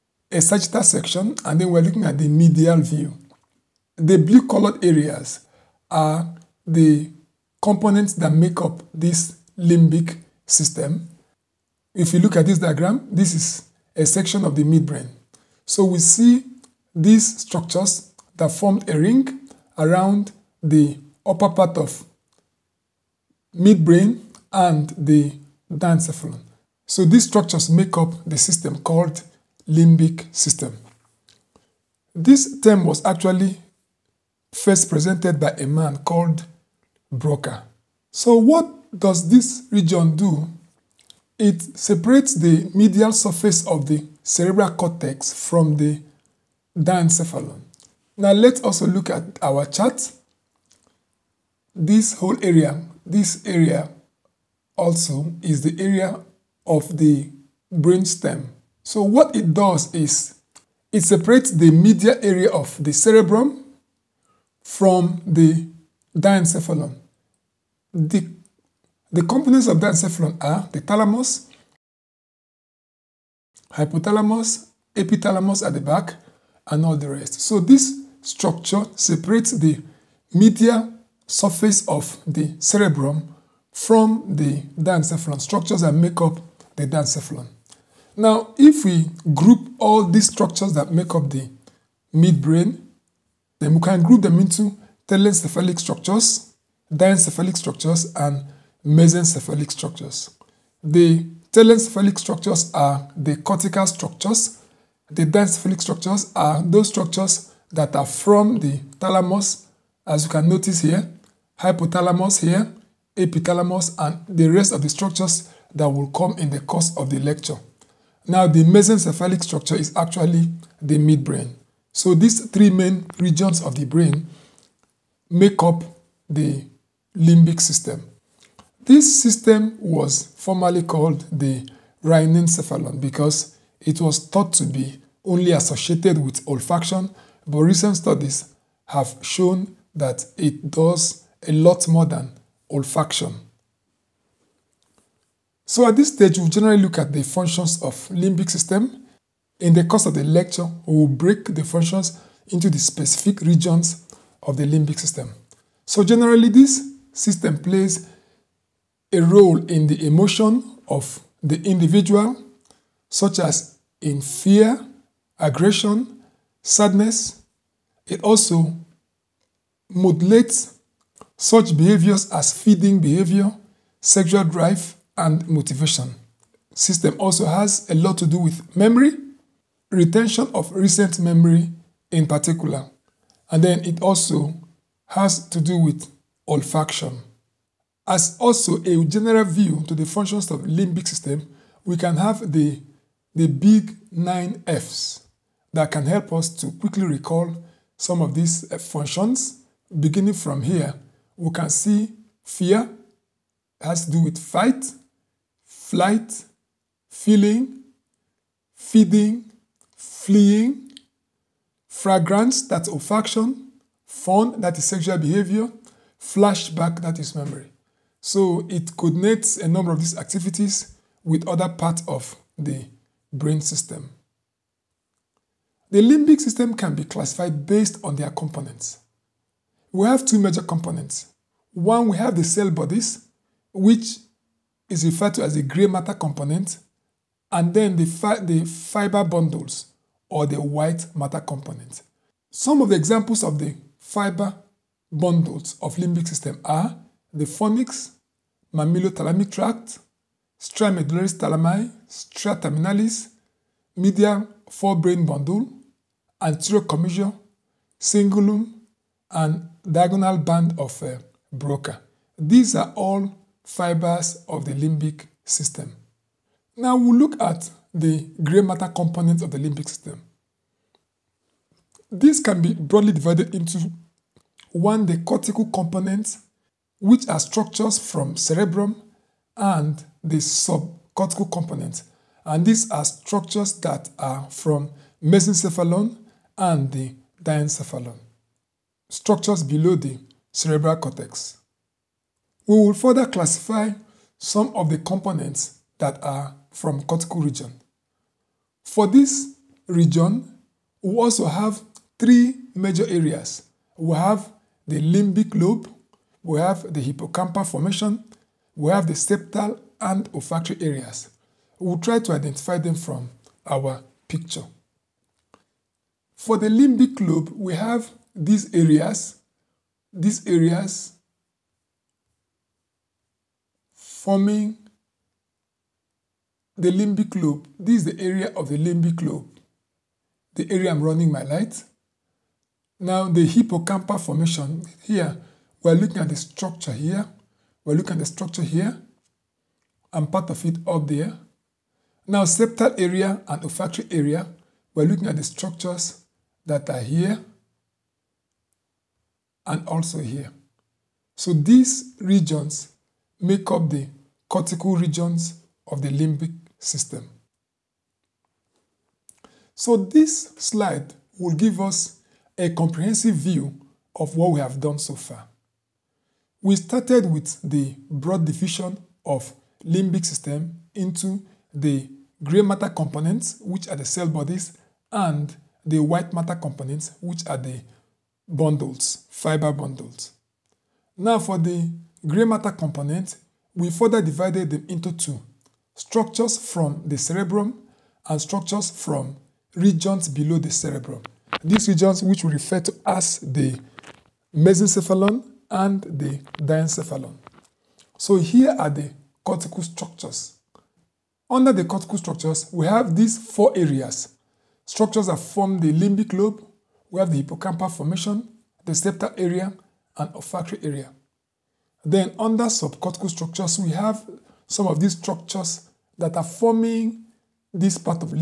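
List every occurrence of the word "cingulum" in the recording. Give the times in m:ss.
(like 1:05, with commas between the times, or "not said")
4:17.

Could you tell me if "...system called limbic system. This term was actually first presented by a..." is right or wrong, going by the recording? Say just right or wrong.
right.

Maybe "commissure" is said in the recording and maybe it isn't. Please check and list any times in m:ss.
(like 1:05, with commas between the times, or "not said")
4:16.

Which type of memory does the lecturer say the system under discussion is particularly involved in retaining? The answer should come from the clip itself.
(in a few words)
recent memory.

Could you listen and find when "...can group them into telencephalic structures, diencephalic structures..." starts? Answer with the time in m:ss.
1:33.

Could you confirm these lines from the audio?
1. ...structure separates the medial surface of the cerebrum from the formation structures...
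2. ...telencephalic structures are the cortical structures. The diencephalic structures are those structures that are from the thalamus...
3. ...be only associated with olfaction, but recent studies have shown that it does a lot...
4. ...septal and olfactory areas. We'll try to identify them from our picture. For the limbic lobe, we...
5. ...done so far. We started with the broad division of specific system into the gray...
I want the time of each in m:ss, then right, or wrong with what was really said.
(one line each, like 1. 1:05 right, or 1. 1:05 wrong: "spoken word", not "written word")
1. 1:18 wrong: "diencephalon", not "formation"
2. 1:41 right
3. 2:14 right
4. 5:09 right
5. 6:04 wrong: "limbic", not "specific".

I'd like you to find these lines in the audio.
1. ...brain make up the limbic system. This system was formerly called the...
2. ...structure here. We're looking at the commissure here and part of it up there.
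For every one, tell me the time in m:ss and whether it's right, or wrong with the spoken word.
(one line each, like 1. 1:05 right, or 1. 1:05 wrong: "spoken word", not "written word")
1. 2:03 right
2. 5:36 wrong: "structure", not "commissure".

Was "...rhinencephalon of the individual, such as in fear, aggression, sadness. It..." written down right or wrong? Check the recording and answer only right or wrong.
wrong.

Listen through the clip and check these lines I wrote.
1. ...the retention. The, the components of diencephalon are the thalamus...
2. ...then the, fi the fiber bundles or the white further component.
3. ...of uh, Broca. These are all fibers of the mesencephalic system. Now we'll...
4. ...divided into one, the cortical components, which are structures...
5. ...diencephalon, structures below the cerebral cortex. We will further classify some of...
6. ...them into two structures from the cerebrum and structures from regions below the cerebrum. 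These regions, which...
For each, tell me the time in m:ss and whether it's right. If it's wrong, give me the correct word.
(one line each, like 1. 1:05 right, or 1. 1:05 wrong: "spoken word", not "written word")
1. 1:05 wrong: "diencephalon", not "retention"
2. 3:57 wrong: "matter", not "further"
3. 4:20 wrong: "limbic", not "mesencephalic"
4. 4:33 right
5. 4:47 right
6. 6:24 right.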